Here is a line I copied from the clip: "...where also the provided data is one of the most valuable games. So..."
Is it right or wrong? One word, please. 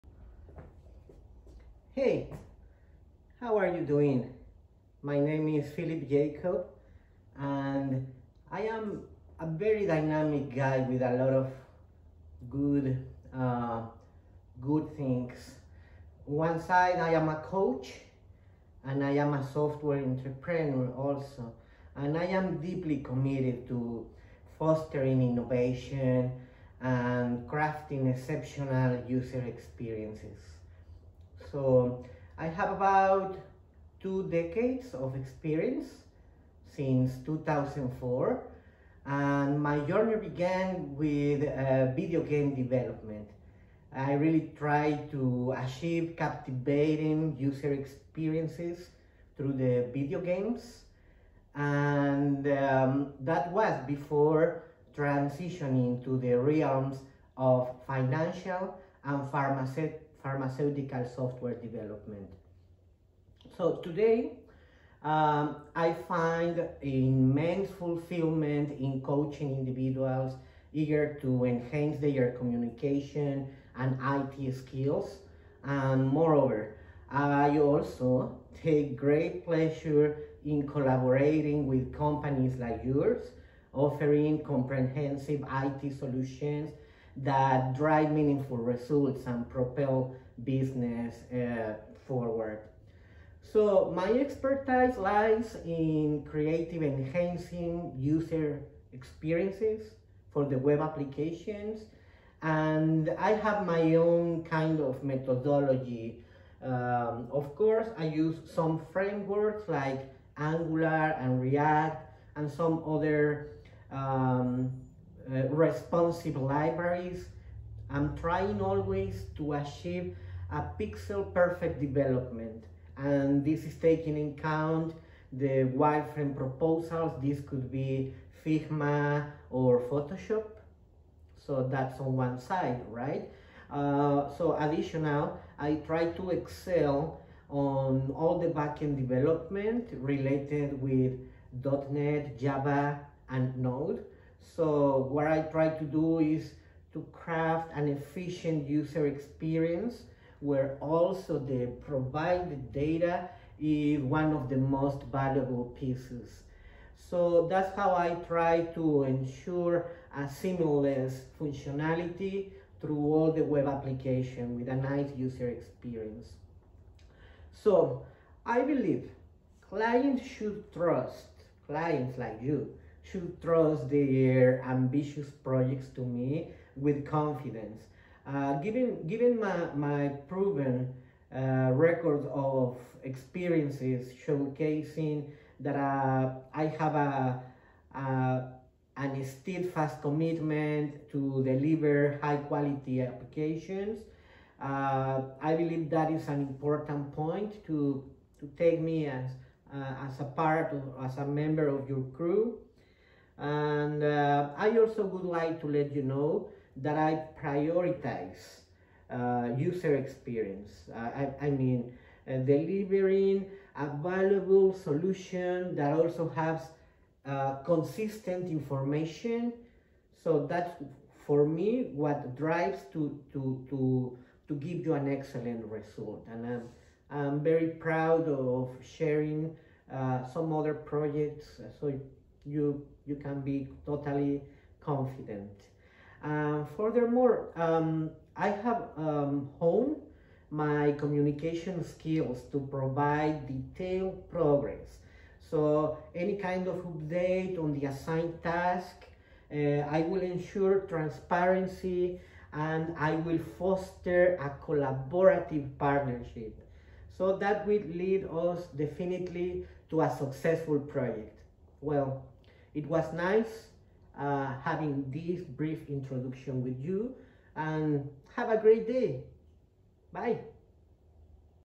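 wrong.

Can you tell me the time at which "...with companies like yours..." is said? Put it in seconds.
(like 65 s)
81 s.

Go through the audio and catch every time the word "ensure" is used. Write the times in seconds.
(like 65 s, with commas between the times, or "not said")
159 s, 250 s.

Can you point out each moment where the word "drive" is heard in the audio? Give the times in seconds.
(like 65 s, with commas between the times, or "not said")
87 s, 222 s.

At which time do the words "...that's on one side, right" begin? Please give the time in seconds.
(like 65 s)
131 s.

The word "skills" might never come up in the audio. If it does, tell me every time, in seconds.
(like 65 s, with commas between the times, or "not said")
74 s, 241 s.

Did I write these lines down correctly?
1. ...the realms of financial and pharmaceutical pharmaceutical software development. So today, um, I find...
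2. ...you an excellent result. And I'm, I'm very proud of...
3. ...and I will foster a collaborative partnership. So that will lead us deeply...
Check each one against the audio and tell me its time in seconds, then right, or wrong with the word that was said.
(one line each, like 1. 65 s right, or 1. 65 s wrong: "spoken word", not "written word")
1. 56 s right
2. 224 s right
3. 252 s wrong: "definitely", not "deeply".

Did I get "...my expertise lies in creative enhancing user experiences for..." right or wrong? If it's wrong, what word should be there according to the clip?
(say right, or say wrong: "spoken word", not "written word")
right.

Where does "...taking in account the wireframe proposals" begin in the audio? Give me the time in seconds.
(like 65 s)
123 s.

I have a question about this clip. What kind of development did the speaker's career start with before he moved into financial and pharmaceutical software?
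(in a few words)
Video game development.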